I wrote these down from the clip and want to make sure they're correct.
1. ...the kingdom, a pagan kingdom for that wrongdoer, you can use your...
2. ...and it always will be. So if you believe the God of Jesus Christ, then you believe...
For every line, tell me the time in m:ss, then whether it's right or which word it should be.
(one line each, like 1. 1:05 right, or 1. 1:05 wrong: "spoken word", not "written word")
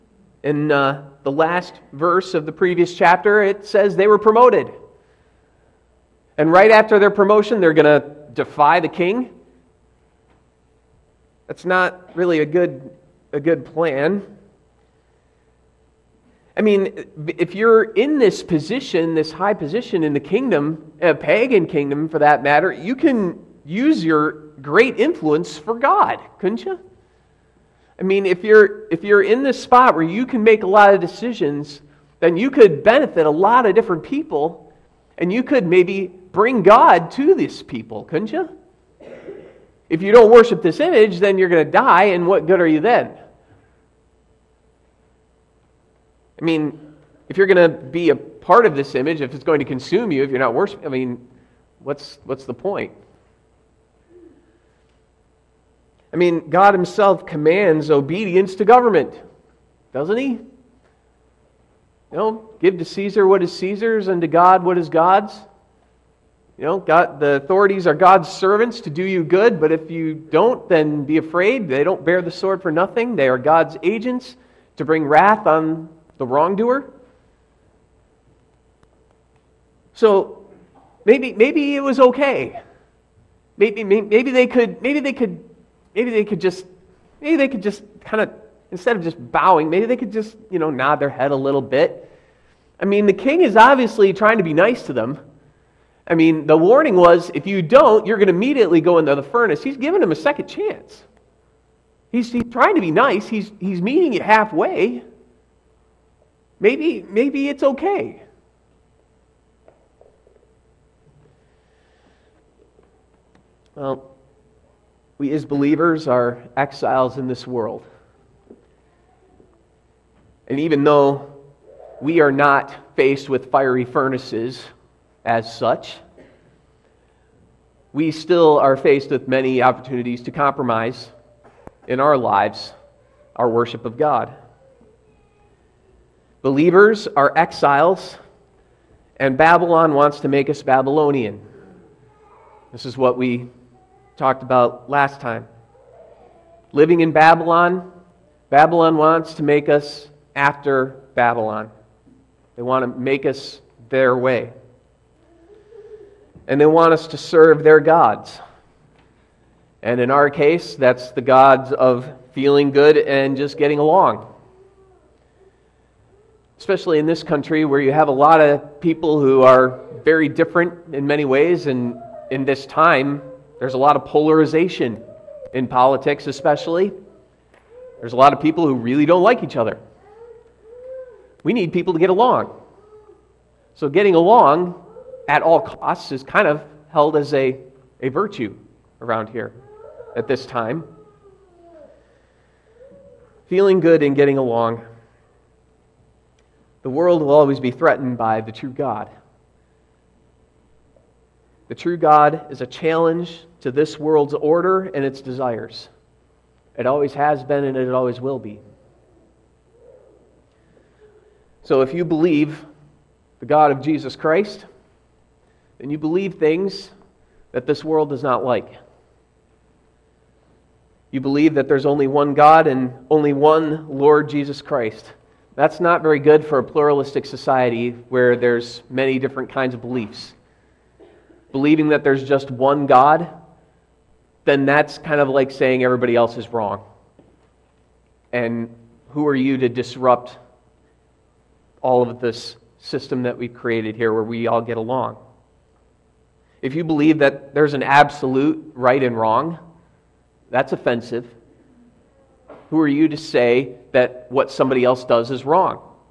1. 0:20 wrong: "matter", not "wrongdoer"
2. 3:27 right.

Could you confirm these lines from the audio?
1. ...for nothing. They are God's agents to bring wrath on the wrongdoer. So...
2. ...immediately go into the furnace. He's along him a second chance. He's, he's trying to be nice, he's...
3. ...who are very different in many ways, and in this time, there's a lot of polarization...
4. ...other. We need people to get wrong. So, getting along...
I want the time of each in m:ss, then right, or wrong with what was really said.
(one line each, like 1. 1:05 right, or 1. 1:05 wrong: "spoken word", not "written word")
1. 1:12 right
2. 1:38 wrong: "giving", not "along"
3. 2:49 right
4. 2:59 wrong: "along", not "wrong".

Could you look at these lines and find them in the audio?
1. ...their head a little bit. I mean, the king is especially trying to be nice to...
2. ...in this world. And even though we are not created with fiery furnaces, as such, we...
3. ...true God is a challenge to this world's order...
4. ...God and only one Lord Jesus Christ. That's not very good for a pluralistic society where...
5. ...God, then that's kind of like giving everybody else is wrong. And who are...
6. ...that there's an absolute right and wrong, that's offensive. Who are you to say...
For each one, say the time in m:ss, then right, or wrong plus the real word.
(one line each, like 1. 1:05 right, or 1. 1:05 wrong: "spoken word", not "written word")
1. 1:30 wrong: "obviously", not "especially"
2. 1:57 wrong: "faced", not "created"
3. 3:21 right
4. 3:42 right
5. 3:52 wrong: "saying", not "giving"
6. 4:07 right.